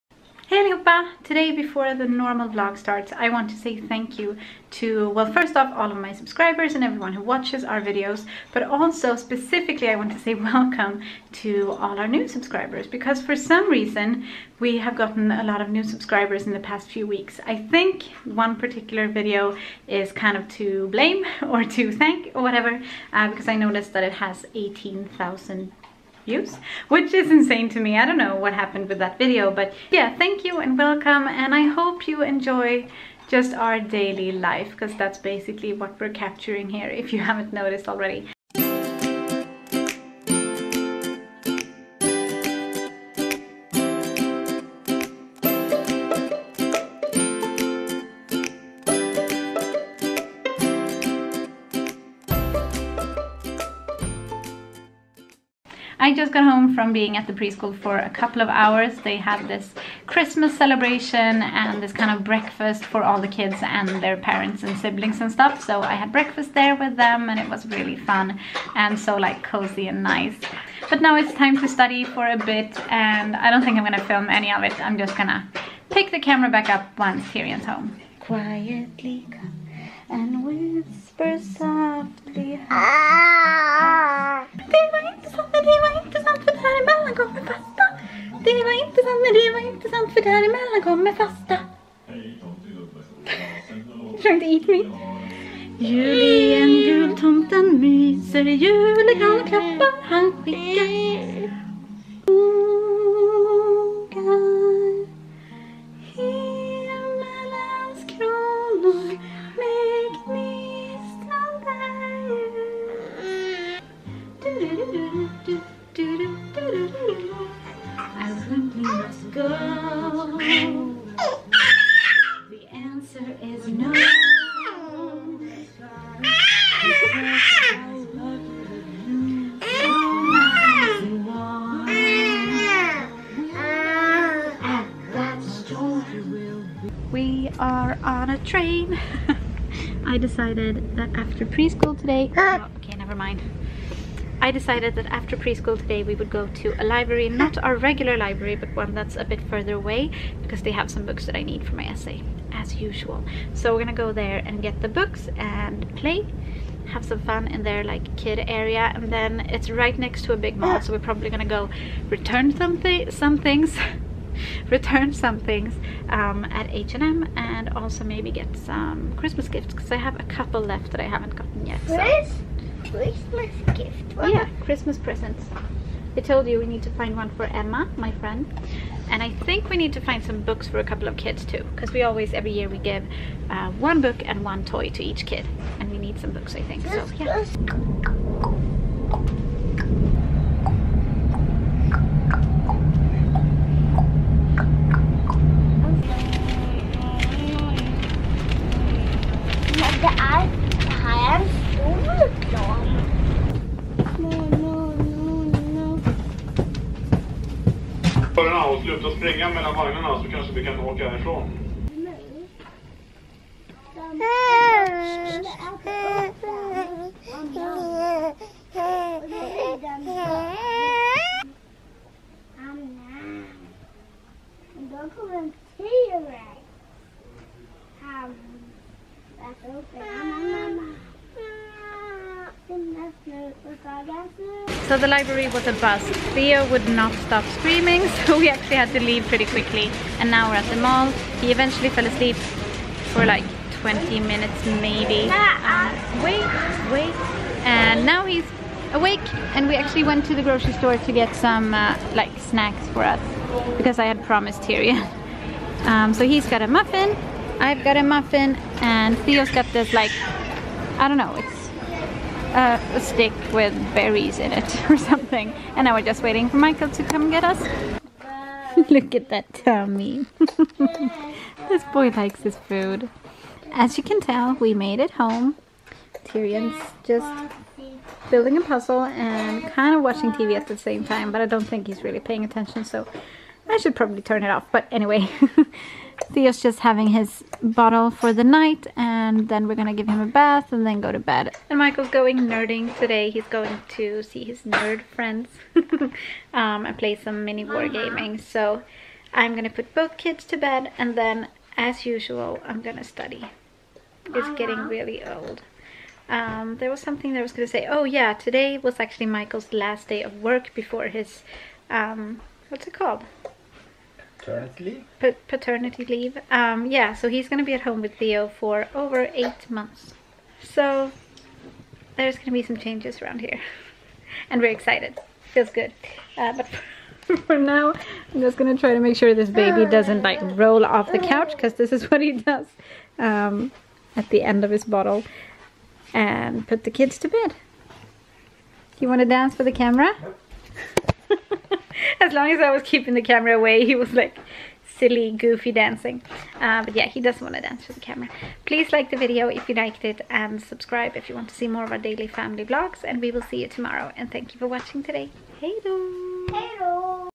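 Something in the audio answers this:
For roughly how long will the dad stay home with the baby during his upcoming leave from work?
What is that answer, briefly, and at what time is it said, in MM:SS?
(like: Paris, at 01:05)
over 8 months, at 05:18.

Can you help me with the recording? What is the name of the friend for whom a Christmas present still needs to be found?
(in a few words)
Emma.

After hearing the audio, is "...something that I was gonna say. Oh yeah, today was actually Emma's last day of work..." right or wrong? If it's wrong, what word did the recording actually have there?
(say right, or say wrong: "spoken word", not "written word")
wrong: "Michael", not "Emma".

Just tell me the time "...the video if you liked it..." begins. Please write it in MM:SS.
05:49.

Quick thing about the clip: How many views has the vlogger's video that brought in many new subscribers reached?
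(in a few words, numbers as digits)
18,000.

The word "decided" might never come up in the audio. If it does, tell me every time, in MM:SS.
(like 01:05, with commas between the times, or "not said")
02:20, 02:24.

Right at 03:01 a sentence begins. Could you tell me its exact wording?
Because we always, every year, we give uh, one book and one toy to each kid.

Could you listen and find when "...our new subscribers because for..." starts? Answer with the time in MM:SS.
00:11.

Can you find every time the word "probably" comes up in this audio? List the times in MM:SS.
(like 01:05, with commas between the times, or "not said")
02:40, 04:43.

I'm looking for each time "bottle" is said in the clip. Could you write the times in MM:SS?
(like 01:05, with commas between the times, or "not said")
04:47, 05:34.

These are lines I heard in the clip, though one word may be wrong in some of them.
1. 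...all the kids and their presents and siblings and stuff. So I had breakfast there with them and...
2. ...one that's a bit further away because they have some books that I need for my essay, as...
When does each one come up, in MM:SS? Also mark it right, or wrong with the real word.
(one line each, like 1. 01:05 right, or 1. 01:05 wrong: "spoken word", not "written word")
1. 01:03 wrong: "parents", not "presents"
2. 02:28 right.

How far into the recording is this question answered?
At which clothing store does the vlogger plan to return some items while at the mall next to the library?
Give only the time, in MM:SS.
02:46.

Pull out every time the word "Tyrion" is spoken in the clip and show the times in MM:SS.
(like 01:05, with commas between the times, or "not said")
01:17, 04:14, 04:36.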